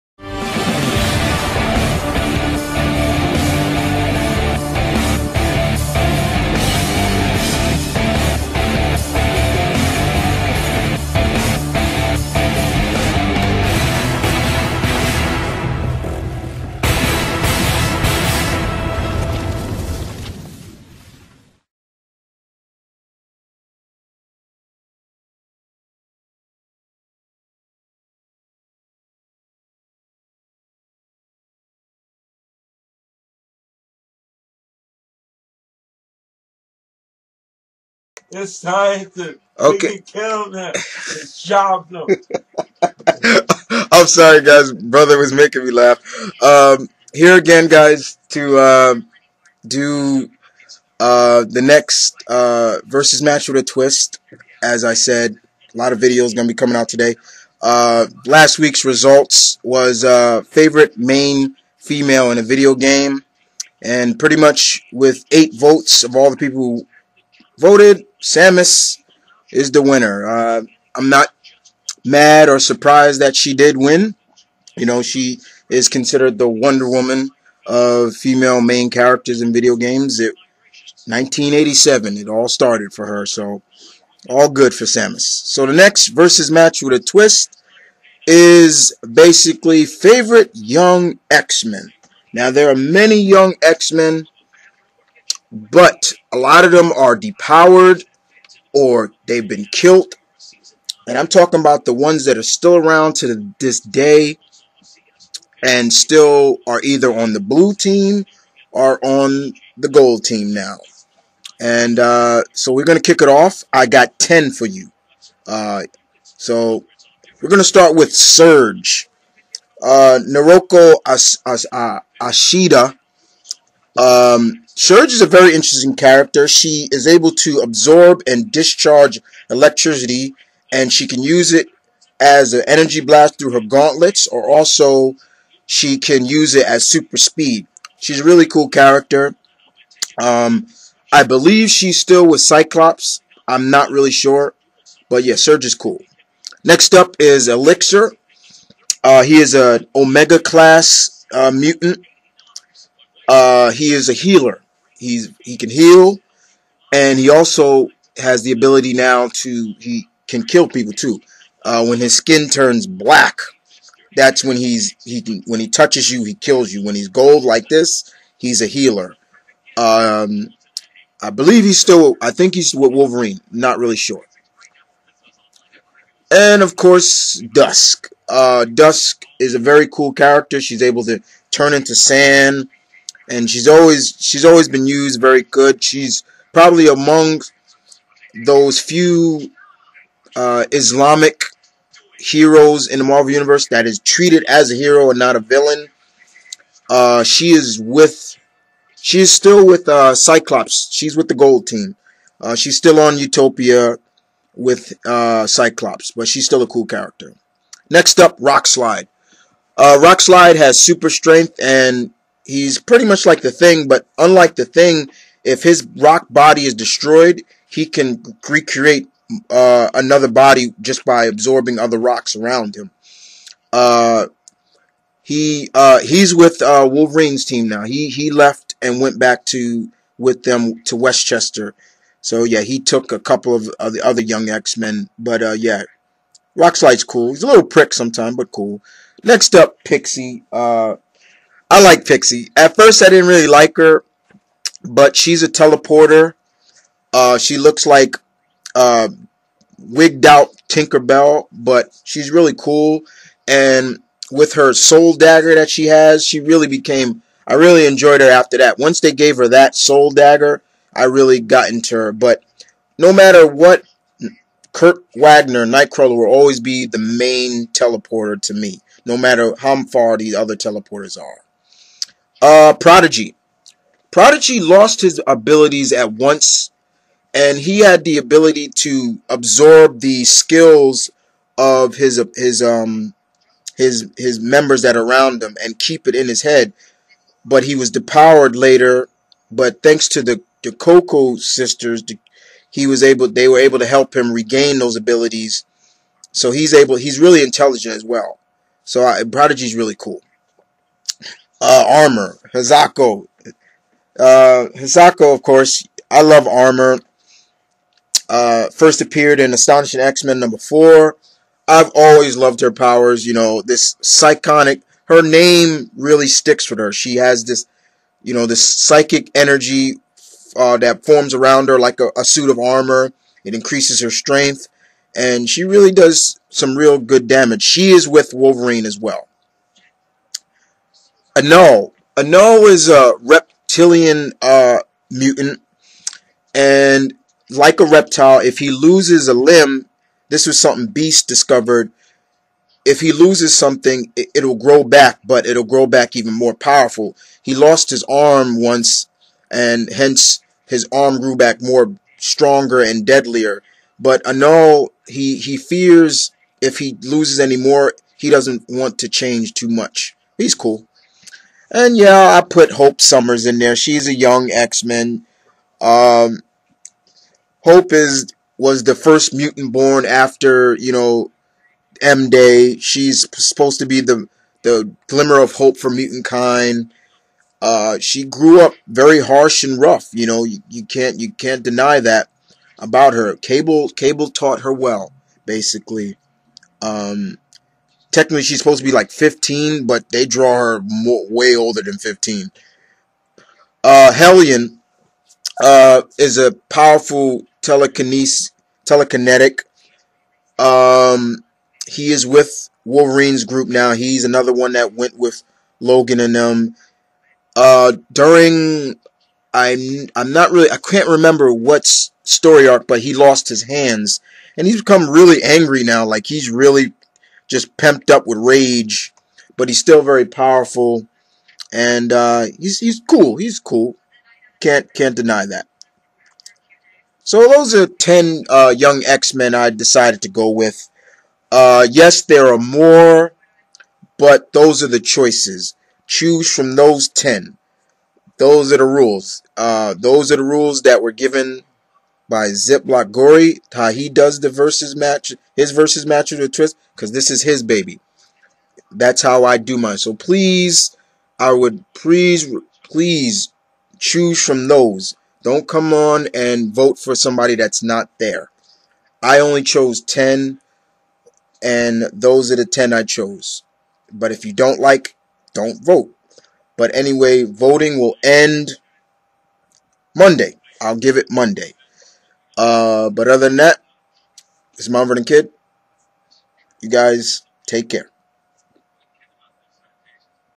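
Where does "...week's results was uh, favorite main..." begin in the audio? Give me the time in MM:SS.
00:58.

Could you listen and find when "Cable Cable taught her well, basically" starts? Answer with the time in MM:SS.
06:23.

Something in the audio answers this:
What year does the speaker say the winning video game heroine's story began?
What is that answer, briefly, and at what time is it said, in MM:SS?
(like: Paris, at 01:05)
1987, at 01:21.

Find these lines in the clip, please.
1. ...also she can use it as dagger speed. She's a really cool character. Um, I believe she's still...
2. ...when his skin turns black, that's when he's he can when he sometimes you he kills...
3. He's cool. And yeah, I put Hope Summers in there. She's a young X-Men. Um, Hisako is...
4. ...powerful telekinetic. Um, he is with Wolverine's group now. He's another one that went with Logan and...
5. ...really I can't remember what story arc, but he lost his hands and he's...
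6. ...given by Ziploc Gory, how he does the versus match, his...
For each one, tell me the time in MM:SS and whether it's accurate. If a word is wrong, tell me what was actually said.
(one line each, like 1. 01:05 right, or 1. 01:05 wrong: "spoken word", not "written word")
1. 02:14 wrong: "super", not "dagger"
2. 02:41 wrong: "touches", not "sometimes"
3. 06:00 wrong: "Hope", not "Hisako"
4. 06:36 right
5. 06:50 right
6. 07:21 right.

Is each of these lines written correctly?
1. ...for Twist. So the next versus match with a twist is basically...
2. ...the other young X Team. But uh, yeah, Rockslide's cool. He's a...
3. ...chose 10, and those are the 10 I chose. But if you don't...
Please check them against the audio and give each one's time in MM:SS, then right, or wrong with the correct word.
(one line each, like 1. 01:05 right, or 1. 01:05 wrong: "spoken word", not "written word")
1. 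01:24 wrong: "Samus", not "Twist"
2. 03:53 wrong: "Men", not "Team"
3. 07:39 right.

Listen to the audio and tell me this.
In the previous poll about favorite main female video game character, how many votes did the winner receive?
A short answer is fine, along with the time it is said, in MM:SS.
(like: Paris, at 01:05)
8, at 01:05.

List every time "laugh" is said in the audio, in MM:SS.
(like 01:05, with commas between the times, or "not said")
00:45.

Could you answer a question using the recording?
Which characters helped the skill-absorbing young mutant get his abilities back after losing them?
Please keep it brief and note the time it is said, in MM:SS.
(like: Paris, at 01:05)
The Cuckoo sisters, at 04:50.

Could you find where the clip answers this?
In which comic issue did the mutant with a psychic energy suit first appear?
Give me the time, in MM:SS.
05:09.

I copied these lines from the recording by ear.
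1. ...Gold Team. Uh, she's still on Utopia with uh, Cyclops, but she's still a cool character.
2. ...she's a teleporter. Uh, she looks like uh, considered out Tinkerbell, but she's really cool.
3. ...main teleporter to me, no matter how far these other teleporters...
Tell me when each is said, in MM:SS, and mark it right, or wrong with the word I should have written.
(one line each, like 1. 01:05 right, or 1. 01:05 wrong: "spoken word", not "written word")
1. 03:21 right
2. 04:05 wrong: "wigged", not "considered"
3. 04:26 right.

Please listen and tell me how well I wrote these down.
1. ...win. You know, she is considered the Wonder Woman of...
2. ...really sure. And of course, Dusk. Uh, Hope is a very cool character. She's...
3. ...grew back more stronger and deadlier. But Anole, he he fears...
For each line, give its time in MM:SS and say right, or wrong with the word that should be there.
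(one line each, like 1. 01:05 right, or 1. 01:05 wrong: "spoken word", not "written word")
1. 01:13 right
2. 02:53 wrong: "Dusk", not "Hope"
3. 05:51 right.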